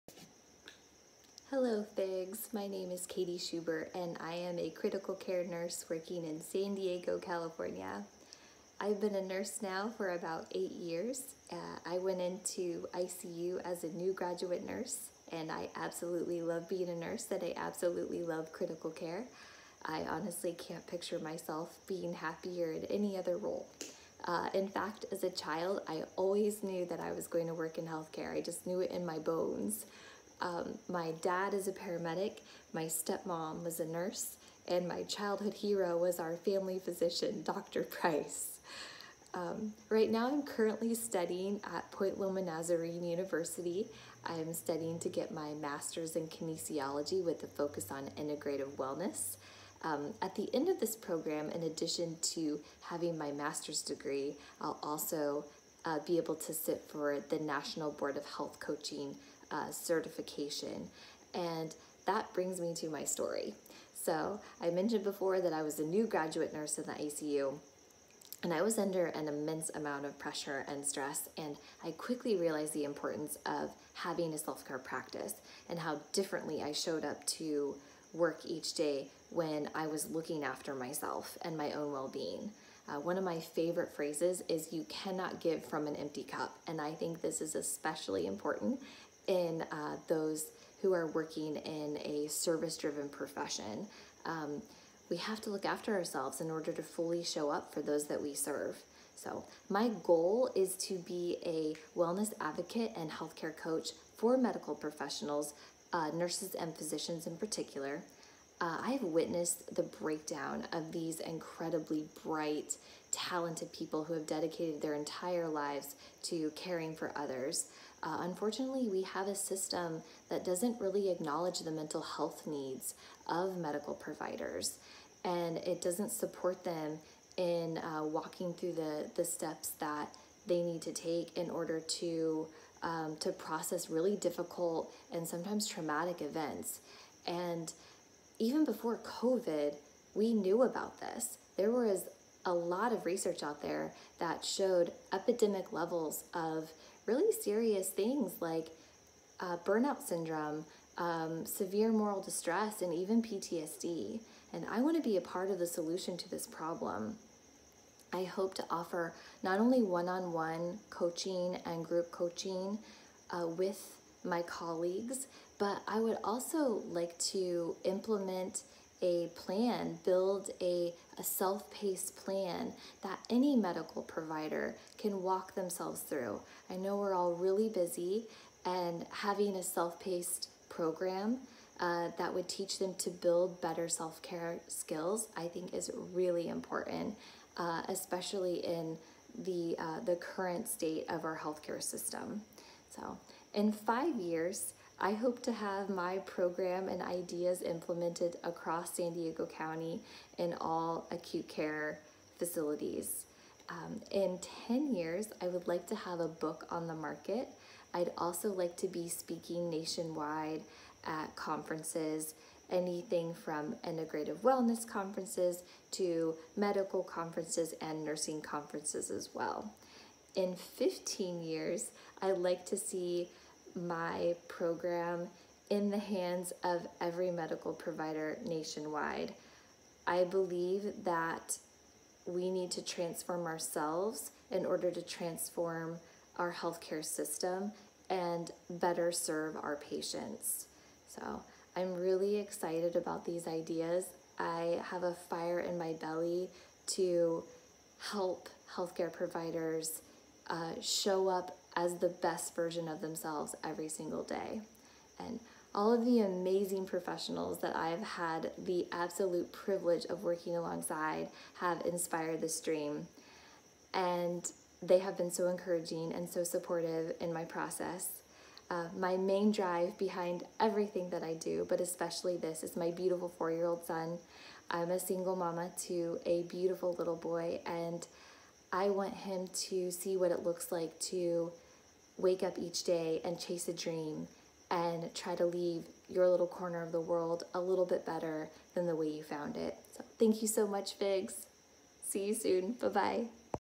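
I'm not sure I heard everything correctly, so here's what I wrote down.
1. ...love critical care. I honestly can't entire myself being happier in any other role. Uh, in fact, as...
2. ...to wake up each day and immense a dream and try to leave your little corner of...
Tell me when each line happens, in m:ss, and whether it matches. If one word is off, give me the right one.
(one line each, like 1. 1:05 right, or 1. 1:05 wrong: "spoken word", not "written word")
1. 0:18 wrong: "picture", not "entire"
2. 4:41 wrong: "chase", not "immense".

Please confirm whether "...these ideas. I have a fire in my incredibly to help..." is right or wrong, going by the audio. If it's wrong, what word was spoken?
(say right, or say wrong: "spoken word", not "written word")
wrong: "belly", not "incredibly".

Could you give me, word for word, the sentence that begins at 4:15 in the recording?
And all of the amazing professionals that I've had the absolute privilege of working alongside have inspired this dream.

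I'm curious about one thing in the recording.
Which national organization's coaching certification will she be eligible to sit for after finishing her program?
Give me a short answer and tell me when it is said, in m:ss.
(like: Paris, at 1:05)
National Board of Health Coaching, at 0:57.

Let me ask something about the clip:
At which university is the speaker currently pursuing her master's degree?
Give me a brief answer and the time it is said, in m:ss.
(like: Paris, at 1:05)
Point Loma Nazarene University, at 0:41.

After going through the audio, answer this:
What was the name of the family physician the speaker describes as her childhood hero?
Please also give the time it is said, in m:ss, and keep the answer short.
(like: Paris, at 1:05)
Dr. Price, at 0:37.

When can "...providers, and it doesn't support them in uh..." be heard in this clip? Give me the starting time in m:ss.
2:03.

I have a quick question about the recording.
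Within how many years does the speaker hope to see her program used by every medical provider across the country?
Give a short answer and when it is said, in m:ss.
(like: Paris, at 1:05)
15, at 3:40.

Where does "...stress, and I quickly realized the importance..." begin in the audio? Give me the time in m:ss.
1:10.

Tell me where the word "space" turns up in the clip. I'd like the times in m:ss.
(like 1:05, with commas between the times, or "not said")
not said.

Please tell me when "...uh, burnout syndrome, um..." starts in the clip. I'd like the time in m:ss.
2:29.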